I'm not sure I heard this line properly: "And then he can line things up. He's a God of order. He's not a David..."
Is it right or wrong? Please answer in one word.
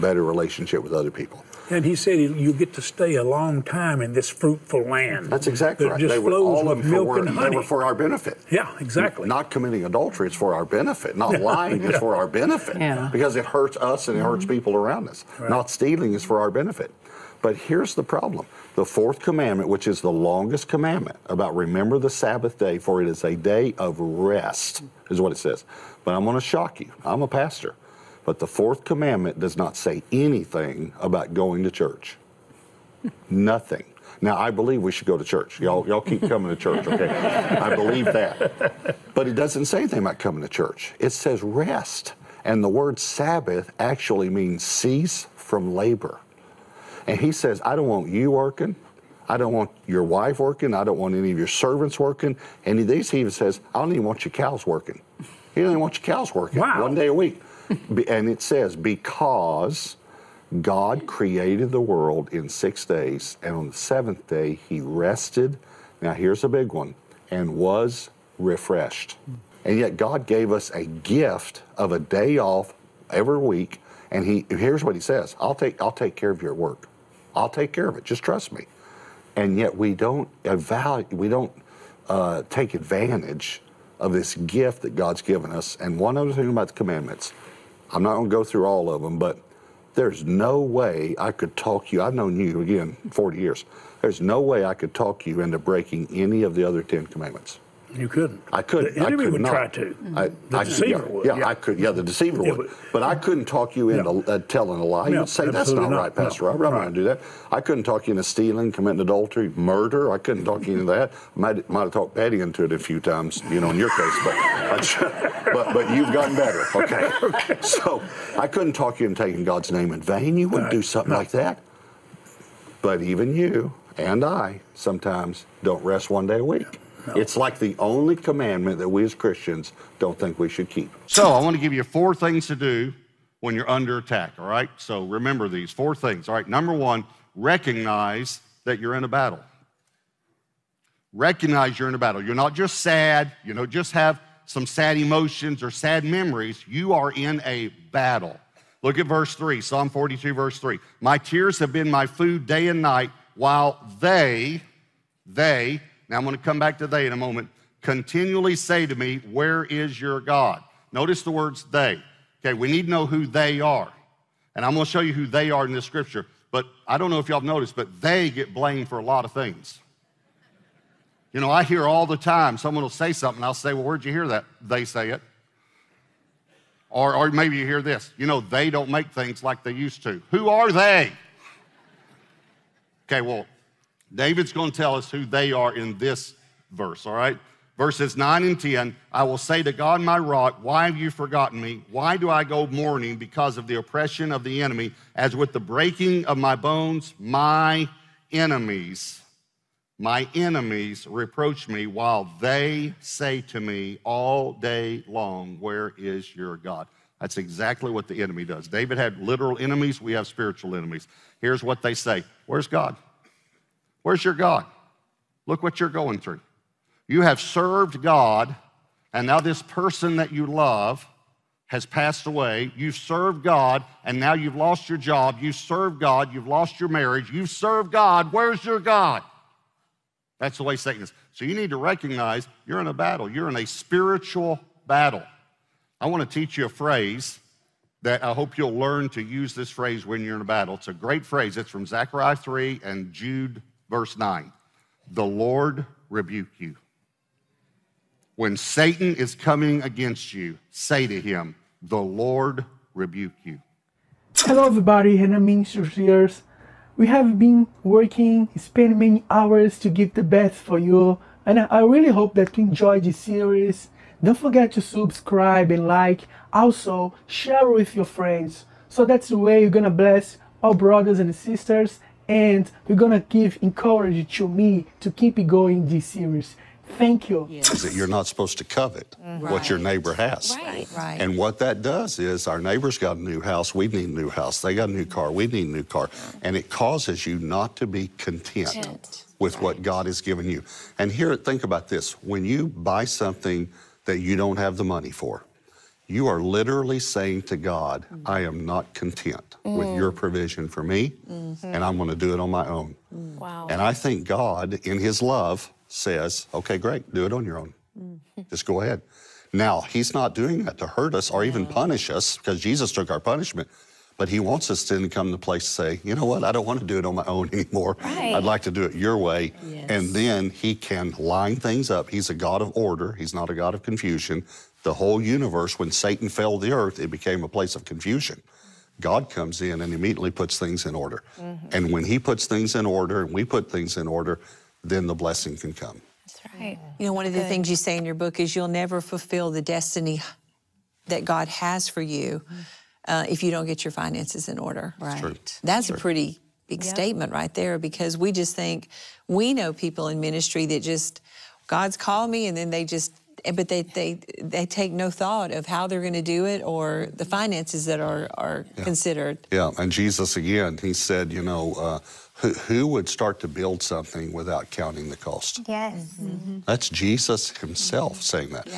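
wrong.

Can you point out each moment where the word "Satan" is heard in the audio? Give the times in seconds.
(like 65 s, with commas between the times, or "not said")
230 s, 248 s, 325 s.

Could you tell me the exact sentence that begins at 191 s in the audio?
Why do I go mourning because of the oppression of the enemy?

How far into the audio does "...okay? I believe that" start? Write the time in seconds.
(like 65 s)
36 s.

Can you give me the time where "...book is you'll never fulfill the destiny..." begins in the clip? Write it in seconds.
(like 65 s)
338 s.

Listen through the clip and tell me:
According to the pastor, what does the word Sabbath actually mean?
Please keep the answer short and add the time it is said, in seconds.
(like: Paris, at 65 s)
cease from labor, at 44 s.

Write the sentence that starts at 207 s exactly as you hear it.
That's exactly what the enemy does.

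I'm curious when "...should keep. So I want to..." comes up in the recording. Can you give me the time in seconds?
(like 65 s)
130 s.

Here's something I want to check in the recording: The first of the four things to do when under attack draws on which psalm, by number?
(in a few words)
Psalm 42.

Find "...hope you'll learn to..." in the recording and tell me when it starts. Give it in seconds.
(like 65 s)
238 s.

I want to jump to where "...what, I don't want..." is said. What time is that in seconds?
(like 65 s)
316 s.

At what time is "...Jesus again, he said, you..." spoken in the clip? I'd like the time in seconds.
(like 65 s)
359 s.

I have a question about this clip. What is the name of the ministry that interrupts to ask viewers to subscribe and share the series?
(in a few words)
Renan Ministries.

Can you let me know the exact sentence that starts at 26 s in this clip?
But I'm going to shock you.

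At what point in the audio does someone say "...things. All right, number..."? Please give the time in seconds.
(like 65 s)
135 s.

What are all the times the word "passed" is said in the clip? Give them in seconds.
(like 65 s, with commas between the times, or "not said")
221 s.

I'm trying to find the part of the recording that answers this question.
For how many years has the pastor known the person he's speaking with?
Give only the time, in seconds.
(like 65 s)
93 s.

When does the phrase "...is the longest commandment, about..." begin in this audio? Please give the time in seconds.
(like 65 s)
19 s.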